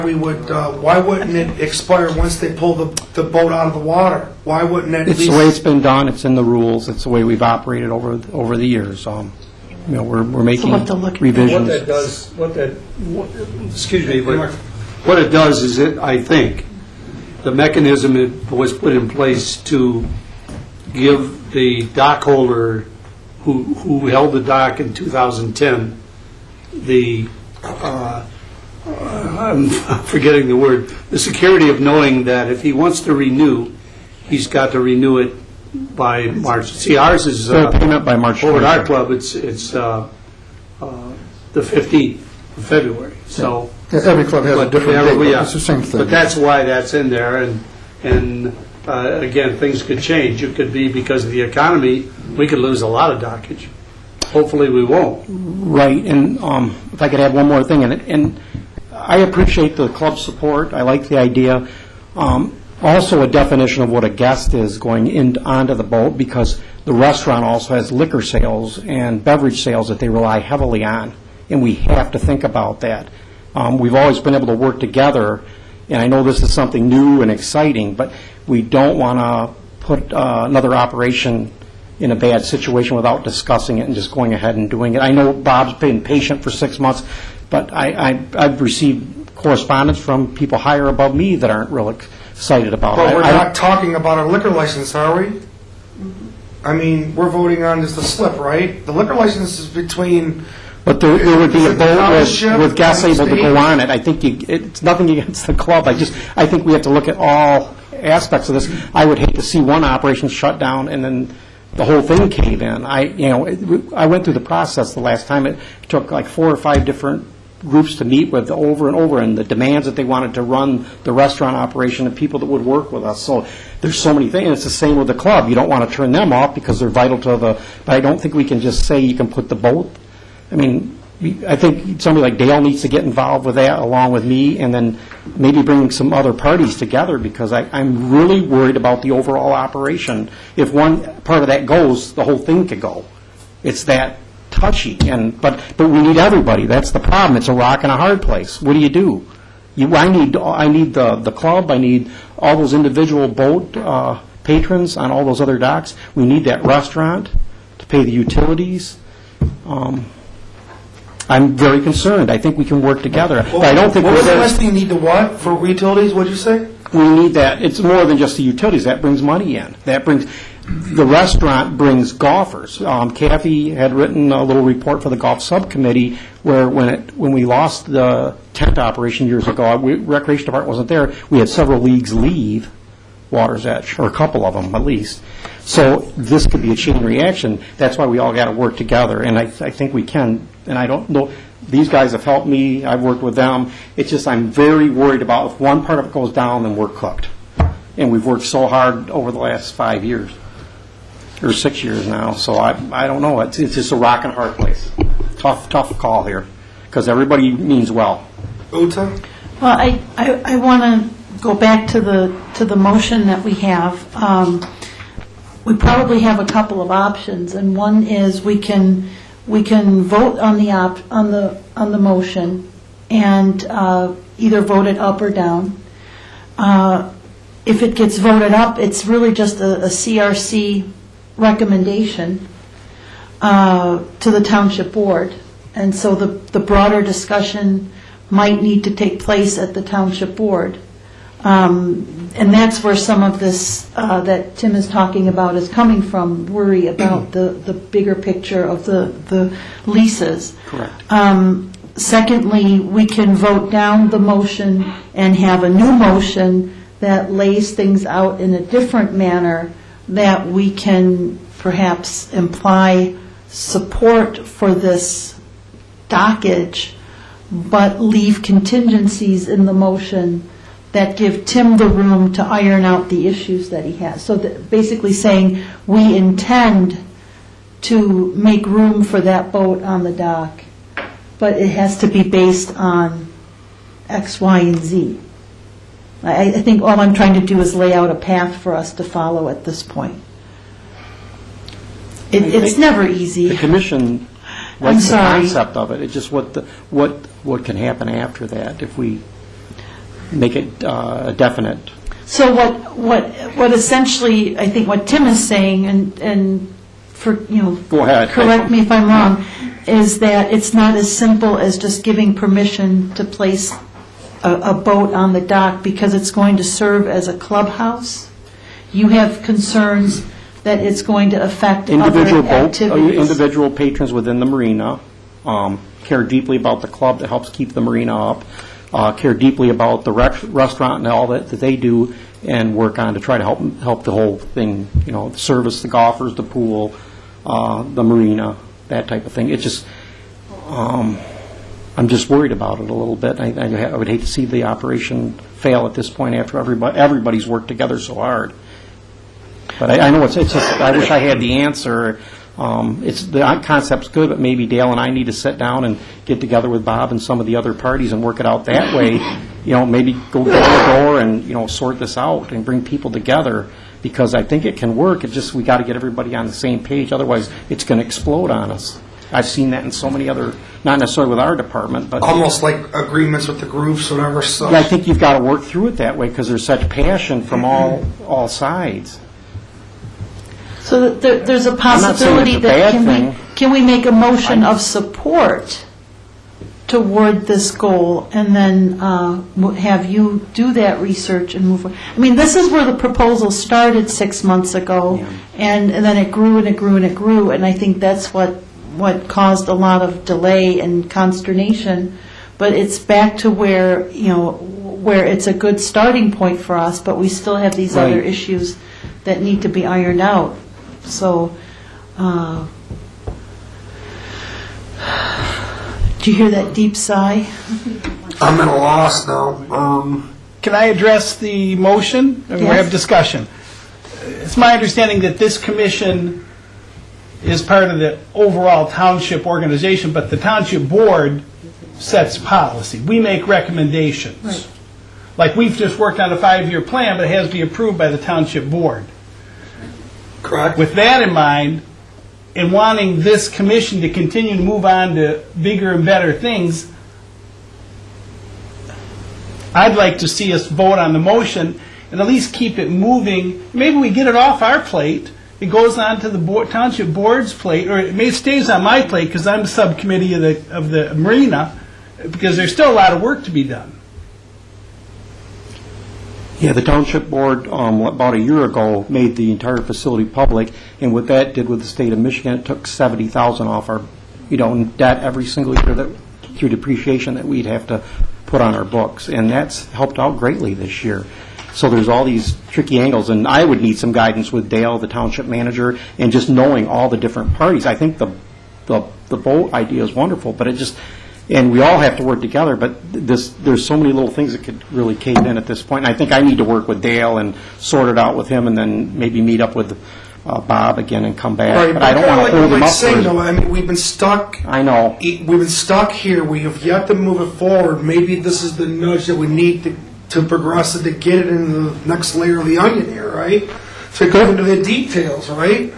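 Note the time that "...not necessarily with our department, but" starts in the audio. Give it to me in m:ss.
6:10.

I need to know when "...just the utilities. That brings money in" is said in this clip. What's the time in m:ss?
2:48.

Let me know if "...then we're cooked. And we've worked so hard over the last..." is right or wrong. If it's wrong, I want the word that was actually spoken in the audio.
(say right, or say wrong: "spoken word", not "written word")
right.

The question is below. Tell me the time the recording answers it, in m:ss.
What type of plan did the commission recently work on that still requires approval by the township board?
7:16.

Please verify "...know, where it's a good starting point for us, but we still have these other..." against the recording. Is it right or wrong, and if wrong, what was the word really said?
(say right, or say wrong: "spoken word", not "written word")
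right.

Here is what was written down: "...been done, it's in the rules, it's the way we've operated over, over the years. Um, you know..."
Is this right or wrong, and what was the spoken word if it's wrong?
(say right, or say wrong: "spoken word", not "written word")
right.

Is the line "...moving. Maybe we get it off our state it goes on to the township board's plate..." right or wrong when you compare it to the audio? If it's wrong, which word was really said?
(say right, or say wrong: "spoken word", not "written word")
wrong: "plate", not "state".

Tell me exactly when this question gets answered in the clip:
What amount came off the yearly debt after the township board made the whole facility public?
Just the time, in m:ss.
7:52.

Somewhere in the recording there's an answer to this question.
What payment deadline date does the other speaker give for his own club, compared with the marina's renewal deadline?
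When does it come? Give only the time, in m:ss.
0:41.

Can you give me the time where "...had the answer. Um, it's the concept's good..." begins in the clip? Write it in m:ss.
5:51.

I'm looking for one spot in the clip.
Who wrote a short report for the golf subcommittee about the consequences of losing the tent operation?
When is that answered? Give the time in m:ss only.
2:53.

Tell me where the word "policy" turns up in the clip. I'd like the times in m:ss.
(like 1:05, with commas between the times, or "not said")
7:12.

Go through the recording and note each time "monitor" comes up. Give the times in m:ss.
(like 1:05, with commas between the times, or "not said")
not said.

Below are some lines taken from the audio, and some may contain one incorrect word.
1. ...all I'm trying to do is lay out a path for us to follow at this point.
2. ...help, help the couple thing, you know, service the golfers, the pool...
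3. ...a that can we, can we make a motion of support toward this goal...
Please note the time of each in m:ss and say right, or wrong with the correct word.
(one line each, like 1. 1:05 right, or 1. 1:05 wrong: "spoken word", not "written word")
1. 4:46 right
2. 5:33 wrong: "whole", not "couple"
3. 6:22 right.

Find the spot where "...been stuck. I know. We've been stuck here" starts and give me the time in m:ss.
8:23.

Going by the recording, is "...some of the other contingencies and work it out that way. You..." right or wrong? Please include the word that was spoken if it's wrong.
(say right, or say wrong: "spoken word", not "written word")
wrong: "parties", not "contingencies".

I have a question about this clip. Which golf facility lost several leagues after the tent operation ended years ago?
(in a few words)
Water's Edge.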